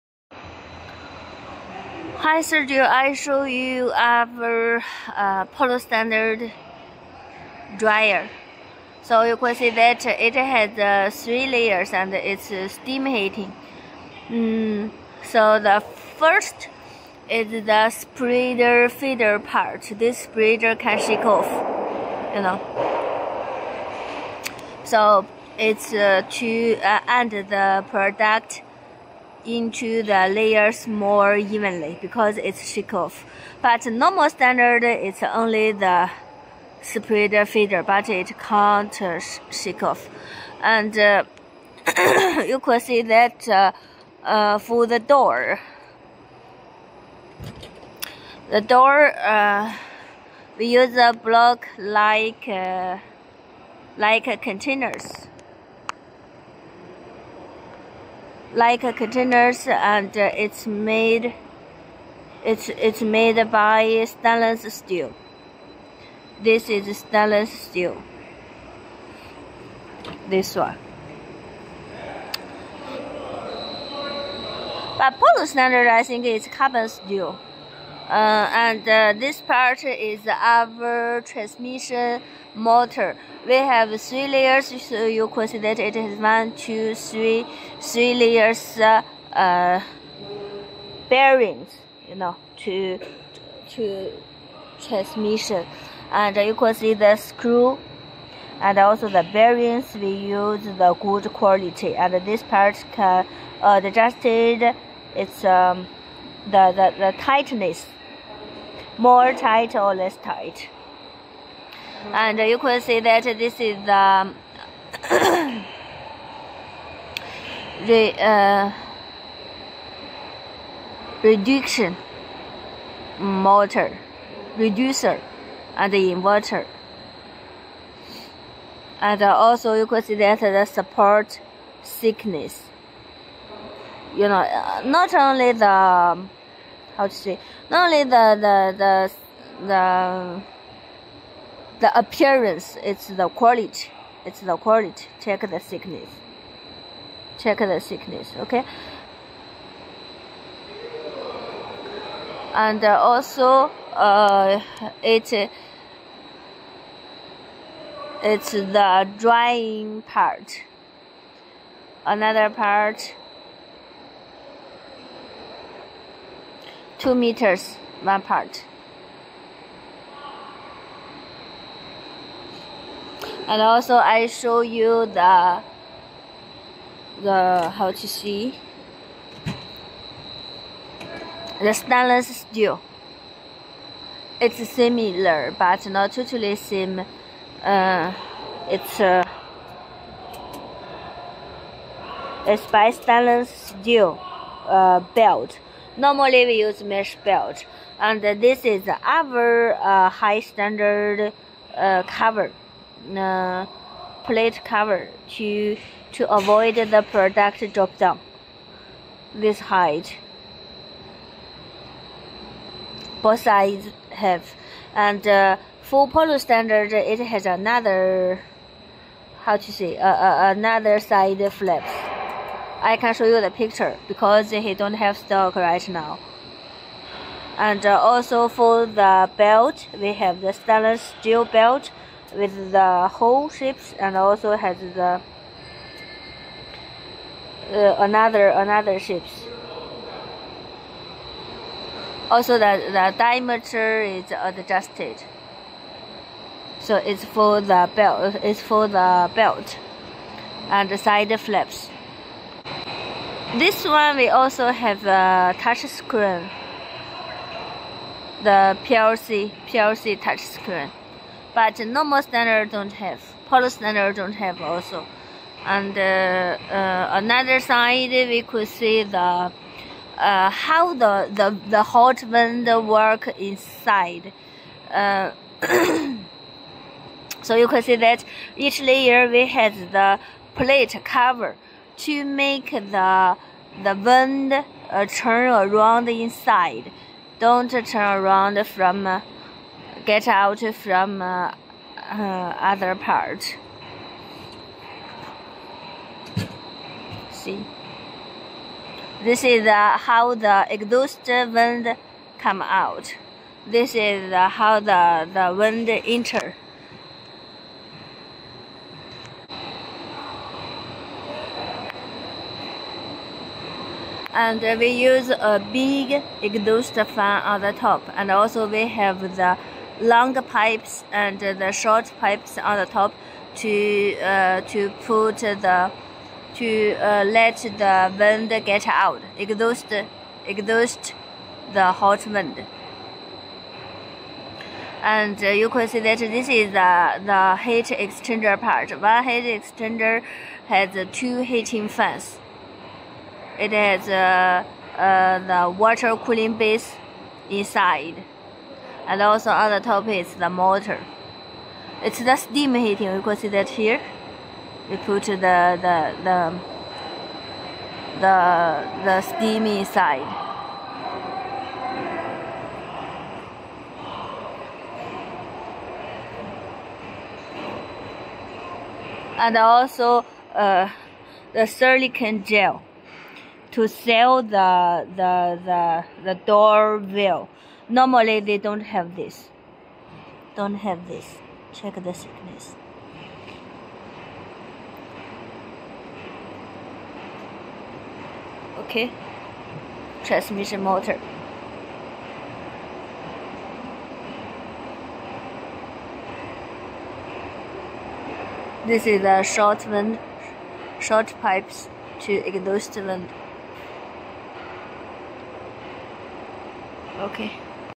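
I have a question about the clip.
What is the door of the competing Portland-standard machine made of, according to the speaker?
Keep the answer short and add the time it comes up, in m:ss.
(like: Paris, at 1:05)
Carbon steel, at 1:16.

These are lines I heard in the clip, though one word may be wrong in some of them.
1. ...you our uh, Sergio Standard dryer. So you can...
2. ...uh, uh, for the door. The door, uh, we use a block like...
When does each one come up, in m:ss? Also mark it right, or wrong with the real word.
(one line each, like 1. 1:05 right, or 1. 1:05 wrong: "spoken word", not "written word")
1. 0:03 wrong: "Polo", not "Sergio"
2. 0:43 right.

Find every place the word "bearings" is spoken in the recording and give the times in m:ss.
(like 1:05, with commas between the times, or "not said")
1:31, 1:39.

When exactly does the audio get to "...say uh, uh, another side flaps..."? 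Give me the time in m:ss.
3:39.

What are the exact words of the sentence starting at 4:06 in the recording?
So it's for the belt, it's for the belt and the side flaps.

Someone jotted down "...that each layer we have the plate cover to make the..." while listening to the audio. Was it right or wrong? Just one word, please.
right.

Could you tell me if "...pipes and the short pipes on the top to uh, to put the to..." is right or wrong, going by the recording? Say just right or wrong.
right.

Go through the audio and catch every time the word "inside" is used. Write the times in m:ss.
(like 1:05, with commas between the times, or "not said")
4:33, 4:46, 5:47, 5:59.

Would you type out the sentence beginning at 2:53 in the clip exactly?
And also I show you the the how to see the stainless steel.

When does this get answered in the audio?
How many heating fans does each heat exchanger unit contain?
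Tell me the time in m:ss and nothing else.
5:41.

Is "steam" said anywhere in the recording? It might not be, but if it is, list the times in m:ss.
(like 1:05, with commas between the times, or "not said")
0:12, 5:52, 5:59.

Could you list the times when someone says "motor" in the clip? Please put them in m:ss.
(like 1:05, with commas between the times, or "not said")
1:22, 2:03, 5:50, 6:30.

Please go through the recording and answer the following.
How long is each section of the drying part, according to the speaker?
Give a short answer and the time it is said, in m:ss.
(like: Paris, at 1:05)
2 meters, at 2:47.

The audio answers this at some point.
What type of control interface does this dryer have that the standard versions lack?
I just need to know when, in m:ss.
4:19.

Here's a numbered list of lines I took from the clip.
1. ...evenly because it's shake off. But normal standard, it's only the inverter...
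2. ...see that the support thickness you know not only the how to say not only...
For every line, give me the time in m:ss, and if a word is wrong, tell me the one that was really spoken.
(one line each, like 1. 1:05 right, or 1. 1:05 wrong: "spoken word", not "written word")
1. 0:31 wrong: "spreader", not "inverter"
2. 2:10 right.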